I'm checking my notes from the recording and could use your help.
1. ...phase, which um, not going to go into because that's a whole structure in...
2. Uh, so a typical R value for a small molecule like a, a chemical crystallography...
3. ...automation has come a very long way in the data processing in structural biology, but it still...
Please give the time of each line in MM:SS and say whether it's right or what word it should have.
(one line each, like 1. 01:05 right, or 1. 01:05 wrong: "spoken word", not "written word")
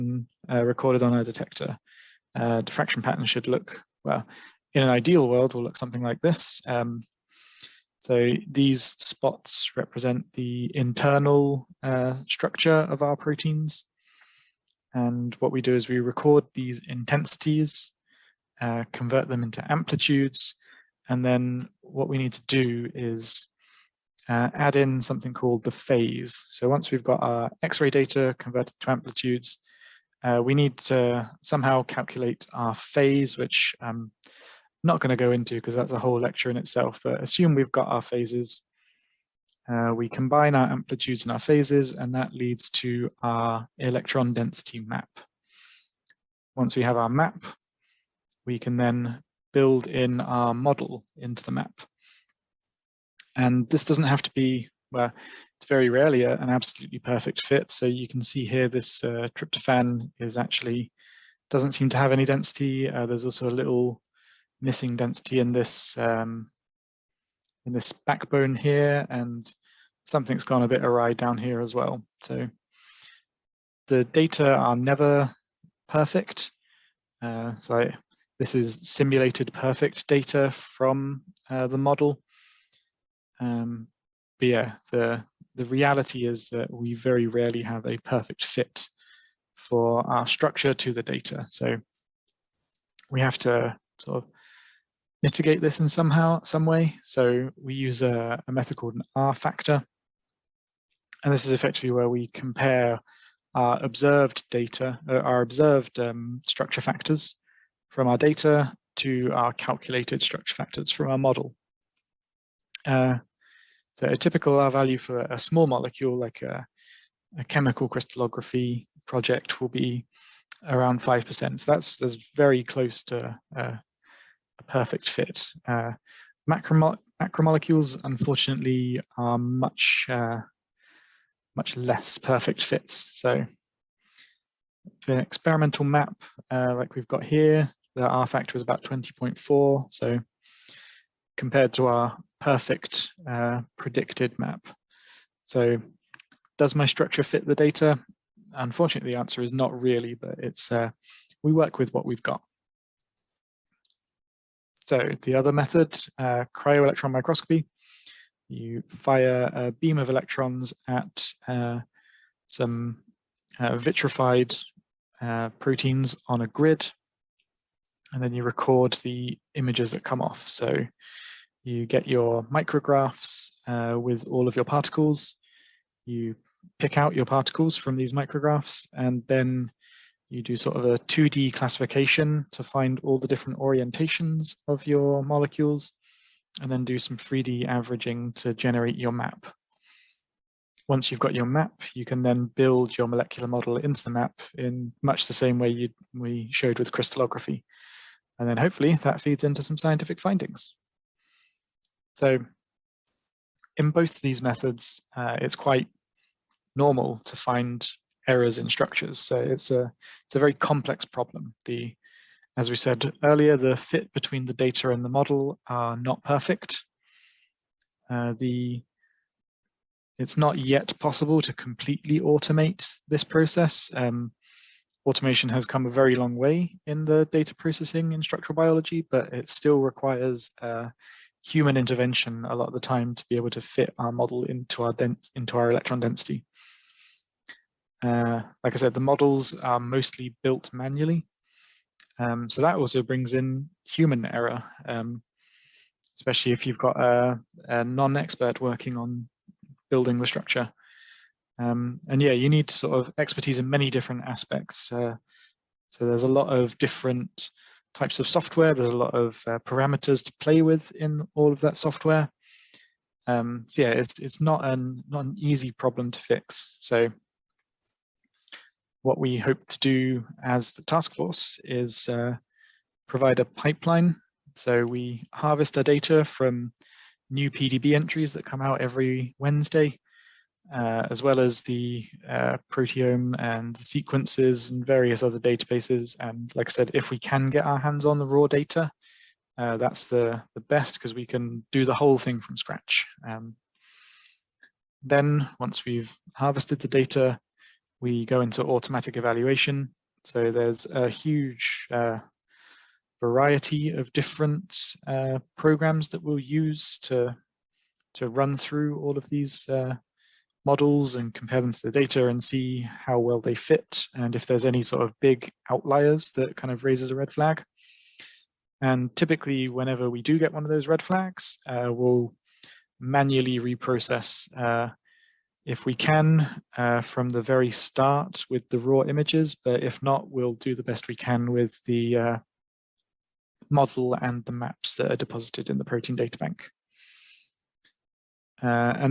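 1. 00:32 wrong: "lecture", not "structure"
2. 01:52 right
3. 03:45 right.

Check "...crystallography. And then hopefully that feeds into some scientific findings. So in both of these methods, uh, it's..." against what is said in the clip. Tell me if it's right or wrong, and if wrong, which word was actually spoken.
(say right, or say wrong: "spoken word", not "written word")
right.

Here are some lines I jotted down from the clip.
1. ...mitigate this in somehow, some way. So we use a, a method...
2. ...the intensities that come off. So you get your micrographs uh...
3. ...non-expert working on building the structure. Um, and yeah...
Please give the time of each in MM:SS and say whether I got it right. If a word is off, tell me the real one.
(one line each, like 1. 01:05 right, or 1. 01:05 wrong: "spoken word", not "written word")
1. 01:35 right
2. 02:48 wrong: "images", not "intensities"
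3. 04:07 right.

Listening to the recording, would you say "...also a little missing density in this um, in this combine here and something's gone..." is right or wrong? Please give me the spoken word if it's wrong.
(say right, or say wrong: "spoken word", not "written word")
wrong: "backbone", not "combine".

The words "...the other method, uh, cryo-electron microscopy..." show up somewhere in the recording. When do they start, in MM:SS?
02:35.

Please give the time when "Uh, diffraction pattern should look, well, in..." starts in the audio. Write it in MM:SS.
00:02.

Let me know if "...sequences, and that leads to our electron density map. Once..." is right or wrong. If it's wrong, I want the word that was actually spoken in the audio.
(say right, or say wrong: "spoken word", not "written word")
wrong: "phases", not "sequences".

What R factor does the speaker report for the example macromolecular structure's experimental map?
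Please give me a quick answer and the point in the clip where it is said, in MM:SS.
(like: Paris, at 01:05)
20.4, at 02:18.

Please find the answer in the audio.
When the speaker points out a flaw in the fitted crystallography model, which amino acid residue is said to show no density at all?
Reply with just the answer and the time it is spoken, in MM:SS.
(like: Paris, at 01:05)
tryptophan, at 00:59.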